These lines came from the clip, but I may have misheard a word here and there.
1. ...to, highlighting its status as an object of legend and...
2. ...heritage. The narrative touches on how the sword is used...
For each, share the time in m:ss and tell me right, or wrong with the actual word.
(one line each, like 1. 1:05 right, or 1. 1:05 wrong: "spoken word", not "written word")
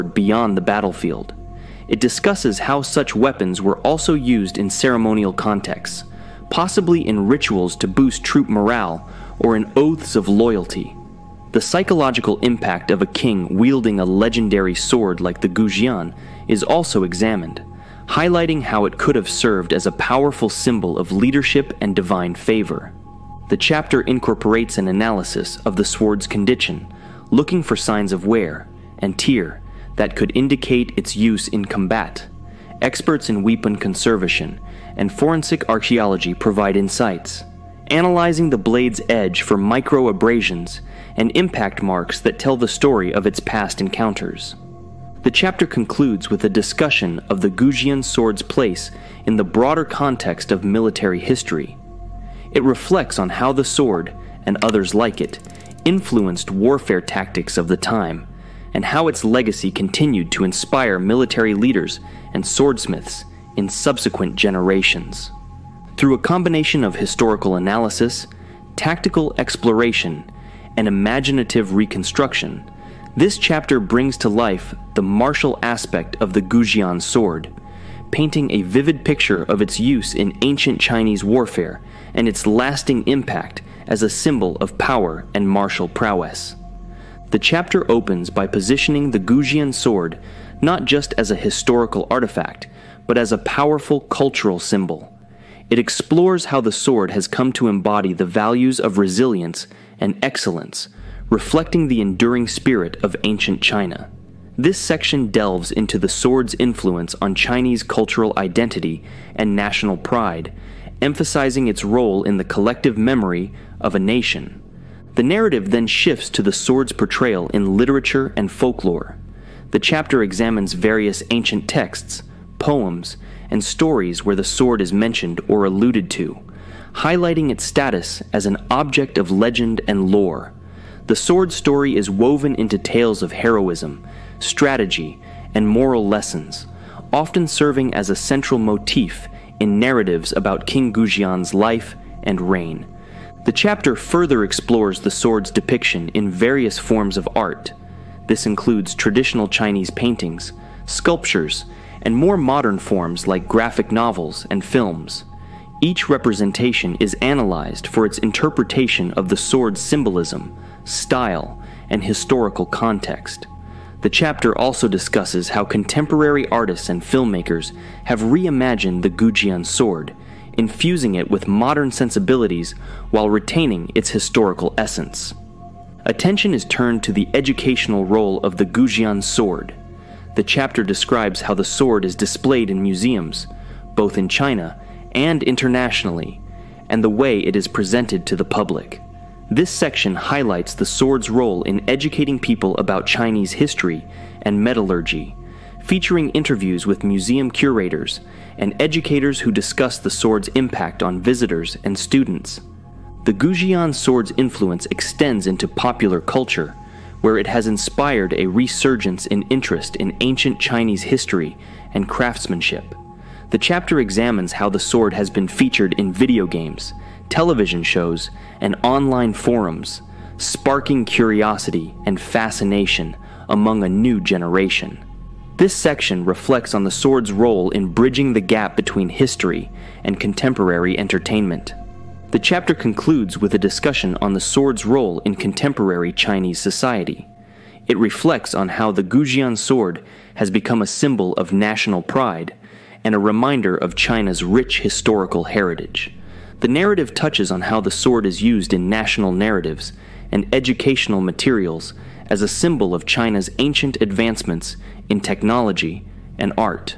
1. 2:06 right
2. 4:05 right.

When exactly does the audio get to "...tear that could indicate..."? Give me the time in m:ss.
0:29.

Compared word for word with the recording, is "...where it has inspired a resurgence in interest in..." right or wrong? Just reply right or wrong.
right.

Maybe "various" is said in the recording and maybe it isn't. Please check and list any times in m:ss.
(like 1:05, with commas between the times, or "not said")
2:00, 2:26.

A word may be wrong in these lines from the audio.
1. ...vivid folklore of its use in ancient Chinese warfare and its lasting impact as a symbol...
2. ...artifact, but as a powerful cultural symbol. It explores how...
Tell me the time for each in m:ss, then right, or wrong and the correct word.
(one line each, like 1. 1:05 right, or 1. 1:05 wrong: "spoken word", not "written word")
1. 1:18 wrong: "picture", not "folklore"
2. 1:32 right.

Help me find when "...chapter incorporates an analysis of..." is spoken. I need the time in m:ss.
0:23.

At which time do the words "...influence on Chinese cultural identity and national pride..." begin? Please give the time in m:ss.
1:46.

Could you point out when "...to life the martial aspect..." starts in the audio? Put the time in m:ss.
1:14.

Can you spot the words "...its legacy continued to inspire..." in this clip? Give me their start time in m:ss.
0:59.